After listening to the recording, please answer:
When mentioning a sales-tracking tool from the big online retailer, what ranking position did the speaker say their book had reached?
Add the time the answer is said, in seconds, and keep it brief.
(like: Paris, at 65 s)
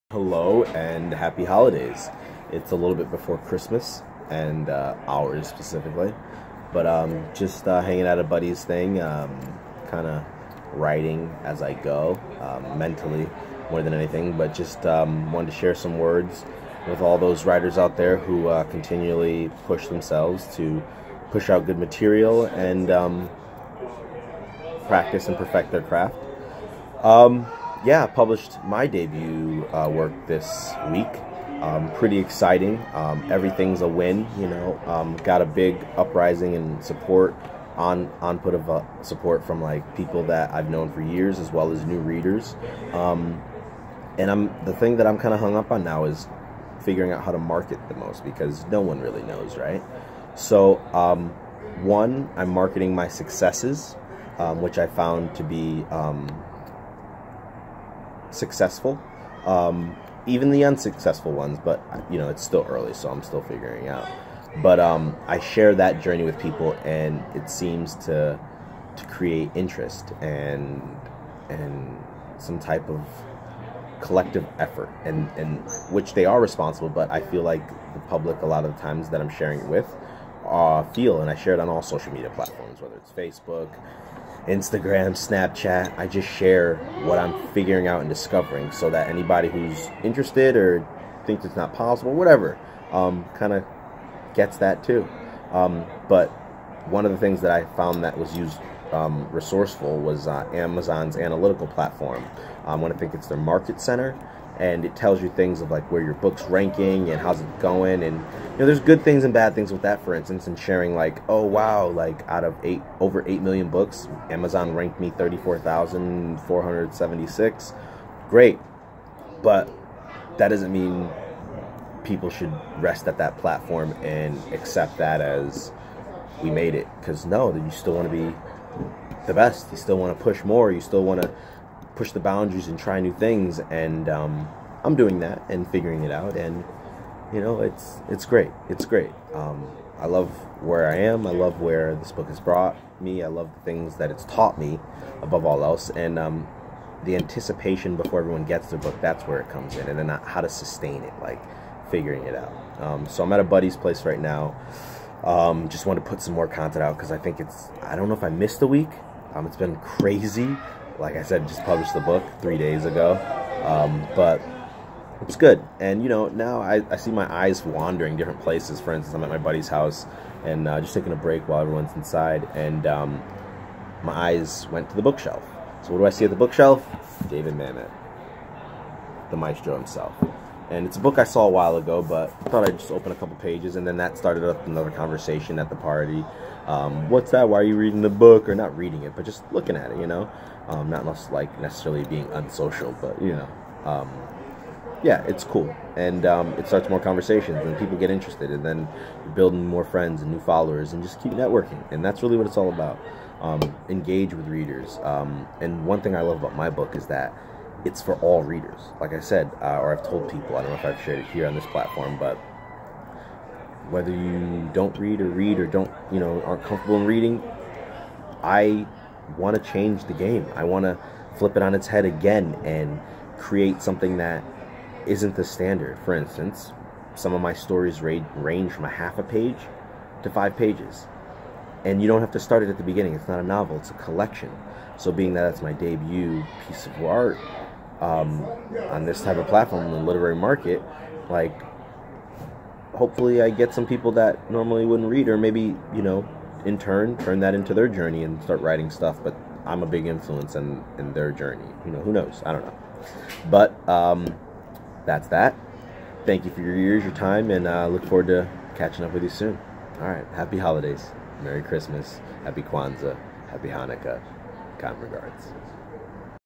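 34476, at 115 s.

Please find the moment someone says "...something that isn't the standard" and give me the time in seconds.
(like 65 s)
223 s.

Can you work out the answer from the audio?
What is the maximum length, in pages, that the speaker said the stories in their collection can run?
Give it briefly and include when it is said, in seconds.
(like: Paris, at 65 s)
5 pages, at 230 s.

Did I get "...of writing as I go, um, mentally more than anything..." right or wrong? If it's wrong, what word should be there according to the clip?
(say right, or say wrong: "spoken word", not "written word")
right.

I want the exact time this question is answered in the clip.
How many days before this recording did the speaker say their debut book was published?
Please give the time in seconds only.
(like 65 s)
162 s.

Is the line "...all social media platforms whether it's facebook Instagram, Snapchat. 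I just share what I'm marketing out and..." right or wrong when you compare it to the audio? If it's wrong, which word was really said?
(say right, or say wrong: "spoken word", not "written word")
wrong: "figuring", not "marketing".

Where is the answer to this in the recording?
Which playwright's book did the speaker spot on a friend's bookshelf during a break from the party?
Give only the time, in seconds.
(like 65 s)
177 s.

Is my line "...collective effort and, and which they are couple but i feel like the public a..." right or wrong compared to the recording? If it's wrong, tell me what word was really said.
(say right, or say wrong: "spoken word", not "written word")
wrong: "responsible", not "couple".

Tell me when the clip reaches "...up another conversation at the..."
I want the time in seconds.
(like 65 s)
184 s.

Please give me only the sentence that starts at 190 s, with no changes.
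Um, not less, like necessarily being unsocial, but you know.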